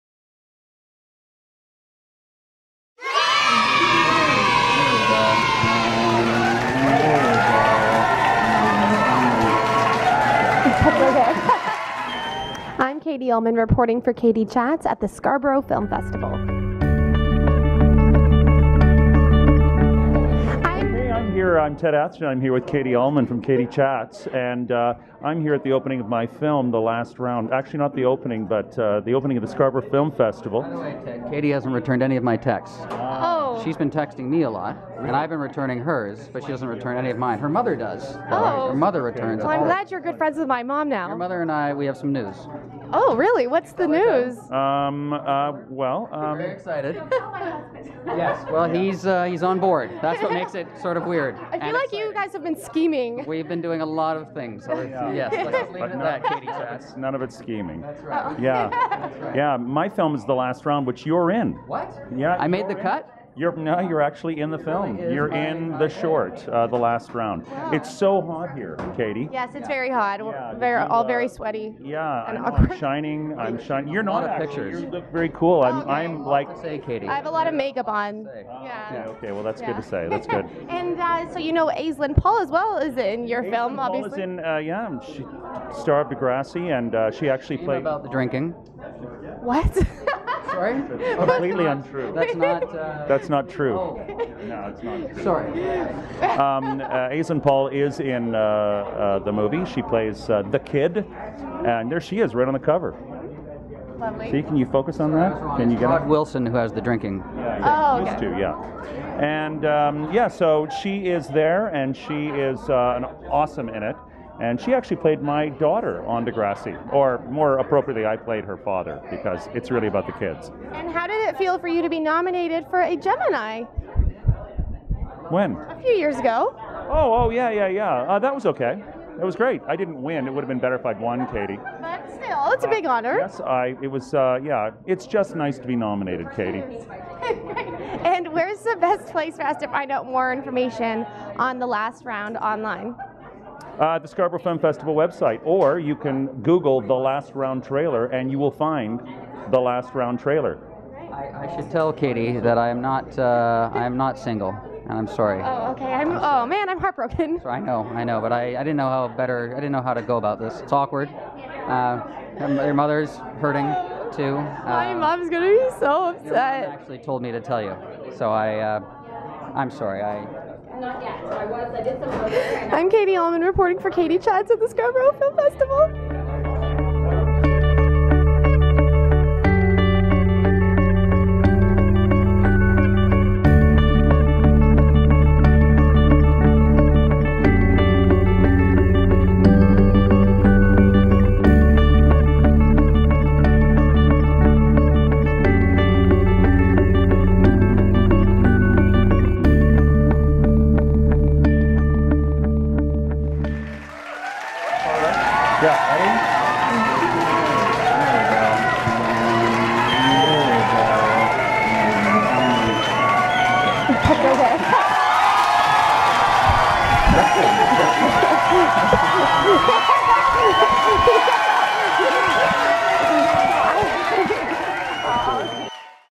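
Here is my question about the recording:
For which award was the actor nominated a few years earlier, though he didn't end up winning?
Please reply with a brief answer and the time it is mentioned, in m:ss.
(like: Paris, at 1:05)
Gemini, at 2:02.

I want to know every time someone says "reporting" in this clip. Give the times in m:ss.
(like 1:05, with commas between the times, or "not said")
0:13, 2:53.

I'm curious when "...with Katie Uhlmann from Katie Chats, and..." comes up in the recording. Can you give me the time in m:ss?
0:22.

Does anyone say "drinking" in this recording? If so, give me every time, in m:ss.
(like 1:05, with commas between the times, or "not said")
1:28, 1:46.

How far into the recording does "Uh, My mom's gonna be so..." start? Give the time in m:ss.
2:44.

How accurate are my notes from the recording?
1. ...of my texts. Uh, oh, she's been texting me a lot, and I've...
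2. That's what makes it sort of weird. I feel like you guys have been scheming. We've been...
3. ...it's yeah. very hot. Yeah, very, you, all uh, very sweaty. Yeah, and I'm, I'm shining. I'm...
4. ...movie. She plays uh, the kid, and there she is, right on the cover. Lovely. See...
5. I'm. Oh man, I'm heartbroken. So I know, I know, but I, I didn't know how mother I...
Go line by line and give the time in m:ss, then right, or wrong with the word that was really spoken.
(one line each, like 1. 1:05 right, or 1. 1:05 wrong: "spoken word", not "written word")
1. 0:32 right
2. 0:50 right
3. 1:09 right
4. 1:39 right
5. 2:35 wrong: "better", not "mother".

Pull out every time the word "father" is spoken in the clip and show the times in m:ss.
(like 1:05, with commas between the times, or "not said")
1:58.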